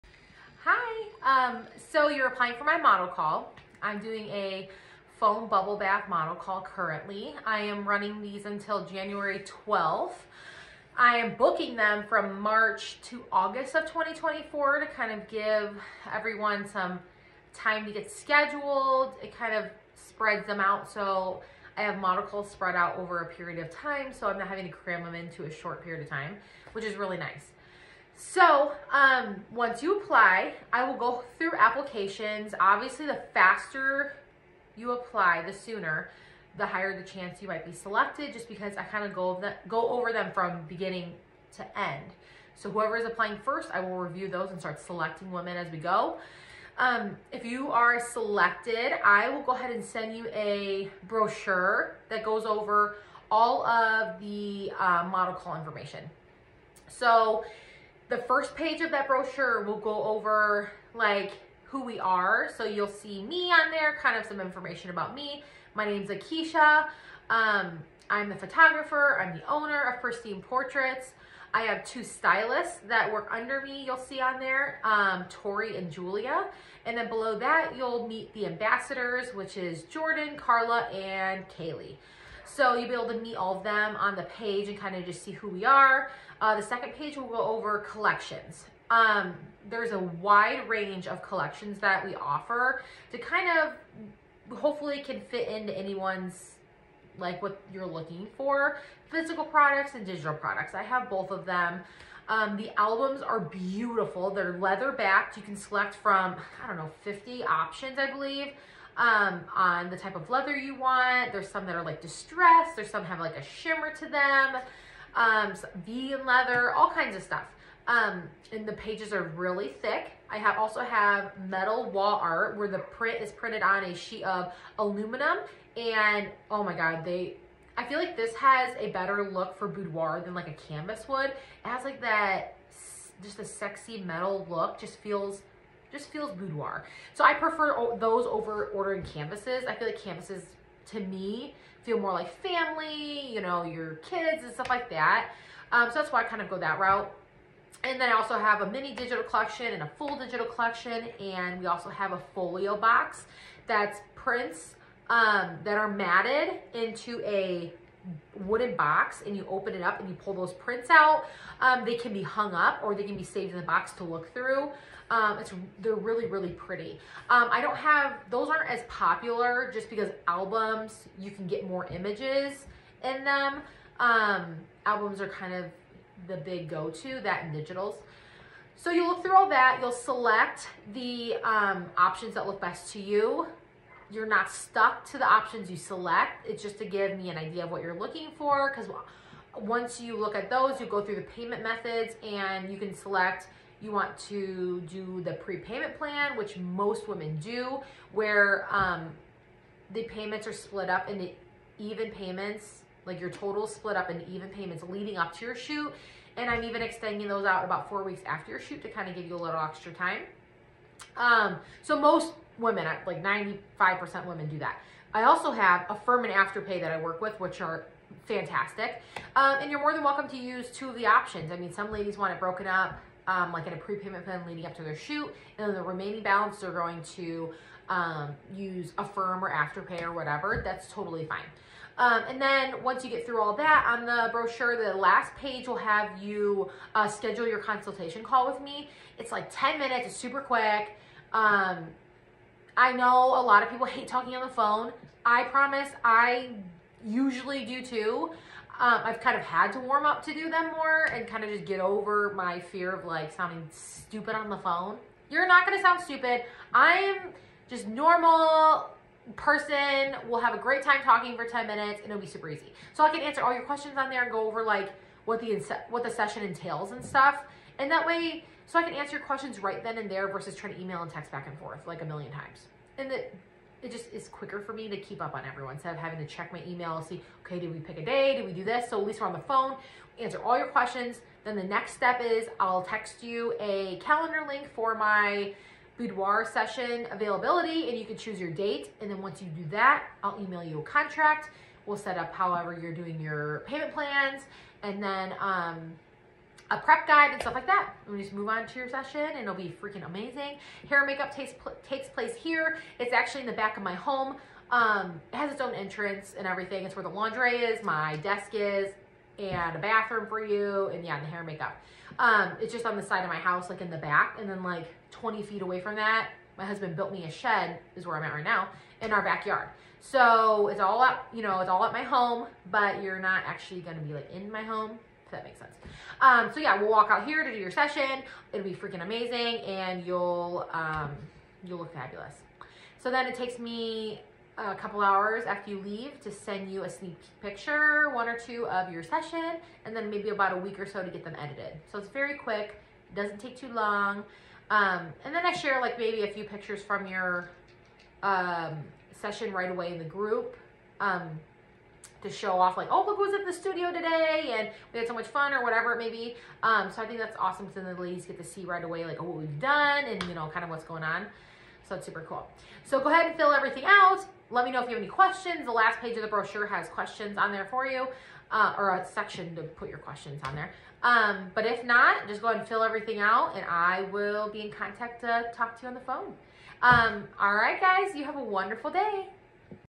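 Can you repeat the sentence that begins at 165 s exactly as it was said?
Um, it's They're really, really pretty.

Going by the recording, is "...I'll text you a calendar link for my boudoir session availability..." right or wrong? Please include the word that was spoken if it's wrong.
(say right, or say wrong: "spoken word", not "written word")
right.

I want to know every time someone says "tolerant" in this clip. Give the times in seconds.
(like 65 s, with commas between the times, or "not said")
not said.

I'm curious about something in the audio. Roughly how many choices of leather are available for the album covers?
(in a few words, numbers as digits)
50.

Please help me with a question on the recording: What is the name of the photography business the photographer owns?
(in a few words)
Pristine Portraits.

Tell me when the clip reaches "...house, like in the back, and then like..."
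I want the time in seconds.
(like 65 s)
313 s.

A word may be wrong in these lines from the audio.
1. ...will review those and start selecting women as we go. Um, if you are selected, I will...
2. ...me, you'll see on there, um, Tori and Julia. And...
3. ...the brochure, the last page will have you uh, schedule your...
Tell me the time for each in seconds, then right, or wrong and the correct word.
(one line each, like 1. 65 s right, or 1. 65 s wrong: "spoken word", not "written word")
1. 43 s right
2. 73 s right
3. 234 s right.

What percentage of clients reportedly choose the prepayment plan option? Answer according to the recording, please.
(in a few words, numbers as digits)
95%.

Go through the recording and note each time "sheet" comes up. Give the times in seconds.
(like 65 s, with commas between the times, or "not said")
123 s.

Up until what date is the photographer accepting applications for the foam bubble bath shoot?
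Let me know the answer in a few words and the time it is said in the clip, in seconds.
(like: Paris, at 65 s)
January 12th, at 8 s.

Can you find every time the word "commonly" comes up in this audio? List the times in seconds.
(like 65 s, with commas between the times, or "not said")
not said.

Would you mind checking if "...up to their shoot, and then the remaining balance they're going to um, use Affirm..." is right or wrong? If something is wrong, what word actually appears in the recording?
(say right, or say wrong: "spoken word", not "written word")
right.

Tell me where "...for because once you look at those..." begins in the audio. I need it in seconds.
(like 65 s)
188 s.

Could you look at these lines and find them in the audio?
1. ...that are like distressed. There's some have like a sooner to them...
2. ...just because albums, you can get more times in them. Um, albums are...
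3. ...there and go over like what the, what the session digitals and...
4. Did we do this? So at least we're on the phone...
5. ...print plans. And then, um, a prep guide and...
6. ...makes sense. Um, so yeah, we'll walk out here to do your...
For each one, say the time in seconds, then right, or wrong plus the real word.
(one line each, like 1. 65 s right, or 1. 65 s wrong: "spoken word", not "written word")
1. 111 s wrong: "shimmer", not "sooner"
2. 169 s wrong: "images", not "times"
3. 264 s wrong: "entails", not "digitals"
4. 278 s right
5. 293 s wrong: "payment", not "print"
6. 325 s right.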